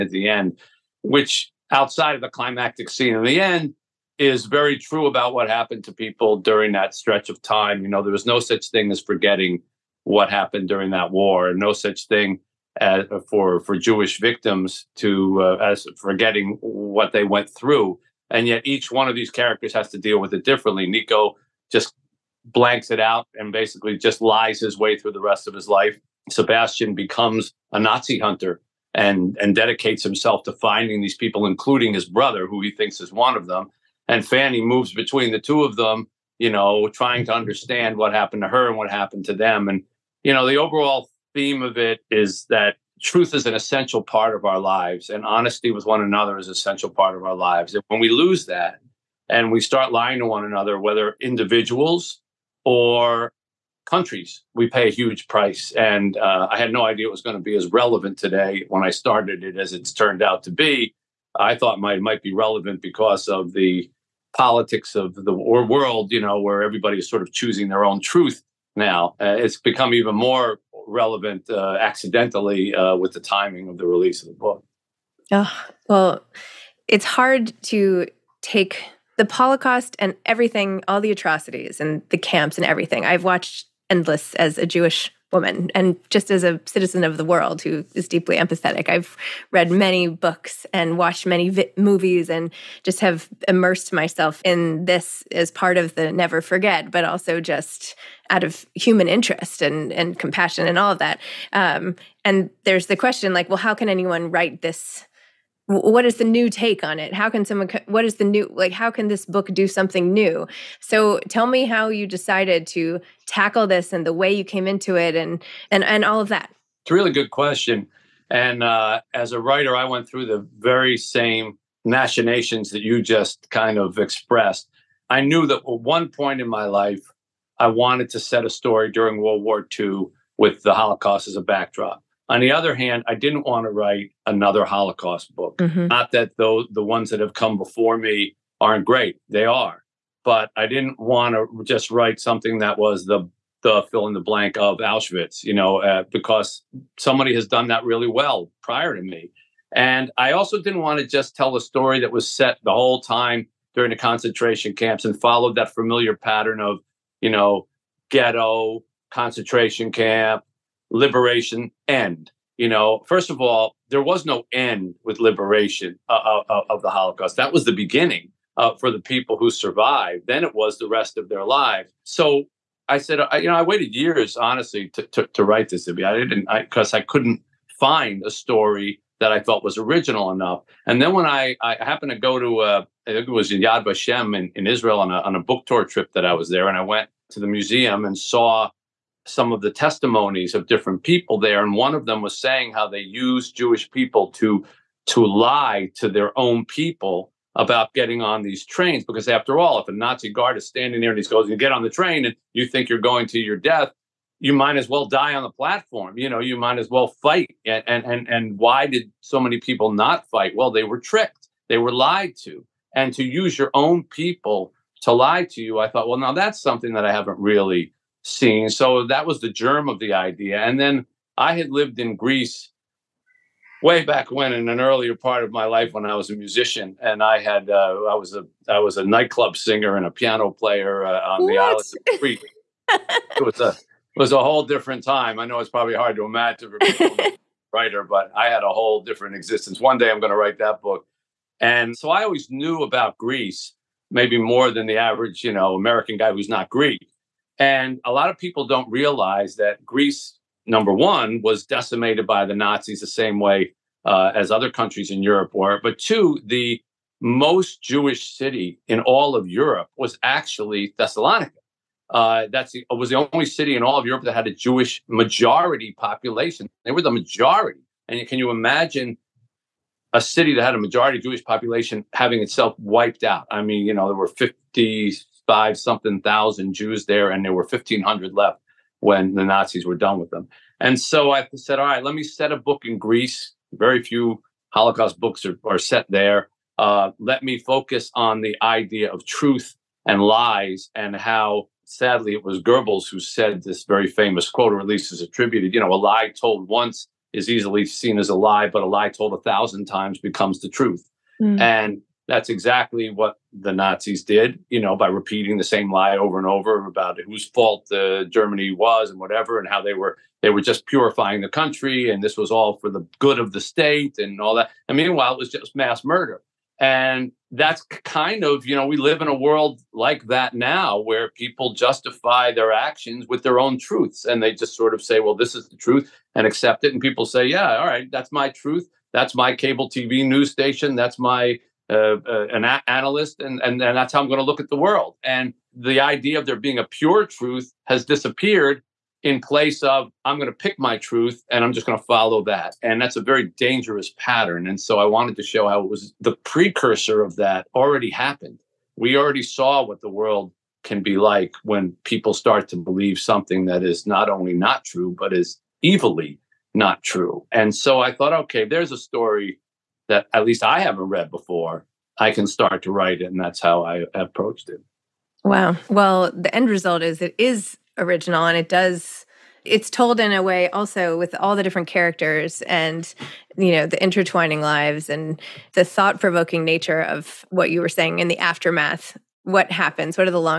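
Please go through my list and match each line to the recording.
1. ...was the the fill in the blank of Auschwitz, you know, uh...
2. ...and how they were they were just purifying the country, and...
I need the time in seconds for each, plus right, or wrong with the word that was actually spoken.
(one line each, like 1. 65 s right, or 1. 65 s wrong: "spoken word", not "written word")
1. 142 s right
2. 309 s right.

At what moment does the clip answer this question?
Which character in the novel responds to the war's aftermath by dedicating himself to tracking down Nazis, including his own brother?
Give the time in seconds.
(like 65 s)
26 s.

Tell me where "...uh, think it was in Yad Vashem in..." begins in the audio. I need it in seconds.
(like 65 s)
182 s.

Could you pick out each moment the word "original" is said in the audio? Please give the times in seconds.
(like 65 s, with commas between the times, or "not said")
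179 s, 367 s.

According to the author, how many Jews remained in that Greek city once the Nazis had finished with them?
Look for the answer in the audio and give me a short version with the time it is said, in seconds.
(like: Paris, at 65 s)
1,500, at 277 s.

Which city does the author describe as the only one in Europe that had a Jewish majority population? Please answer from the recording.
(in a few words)
Thessalonica.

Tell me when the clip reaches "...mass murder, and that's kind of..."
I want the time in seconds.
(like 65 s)
315 s.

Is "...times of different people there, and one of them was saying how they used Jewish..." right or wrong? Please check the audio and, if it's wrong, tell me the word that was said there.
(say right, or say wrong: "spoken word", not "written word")
wrong: "testimonies", not "times".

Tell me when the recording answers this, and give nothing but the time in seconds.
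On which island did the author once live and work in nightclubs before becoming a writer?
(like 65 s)
232 s.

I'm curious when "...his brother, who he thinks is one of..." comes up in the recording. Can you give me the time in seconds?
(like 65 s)
31 s.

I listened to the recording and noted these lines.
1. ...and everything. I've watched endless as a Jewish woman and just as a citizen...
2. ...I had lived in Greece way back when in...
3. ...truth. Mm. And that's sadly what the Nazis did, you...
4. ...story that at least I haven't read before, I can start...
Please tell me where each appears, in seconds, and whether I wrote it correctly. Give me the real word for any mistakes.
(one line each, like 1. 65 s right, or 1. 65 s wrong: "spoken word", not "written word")
1. 82 s right
2. 221 s right
3. 300 s wrong: "exactly", not "sadly"
4. 358 s right.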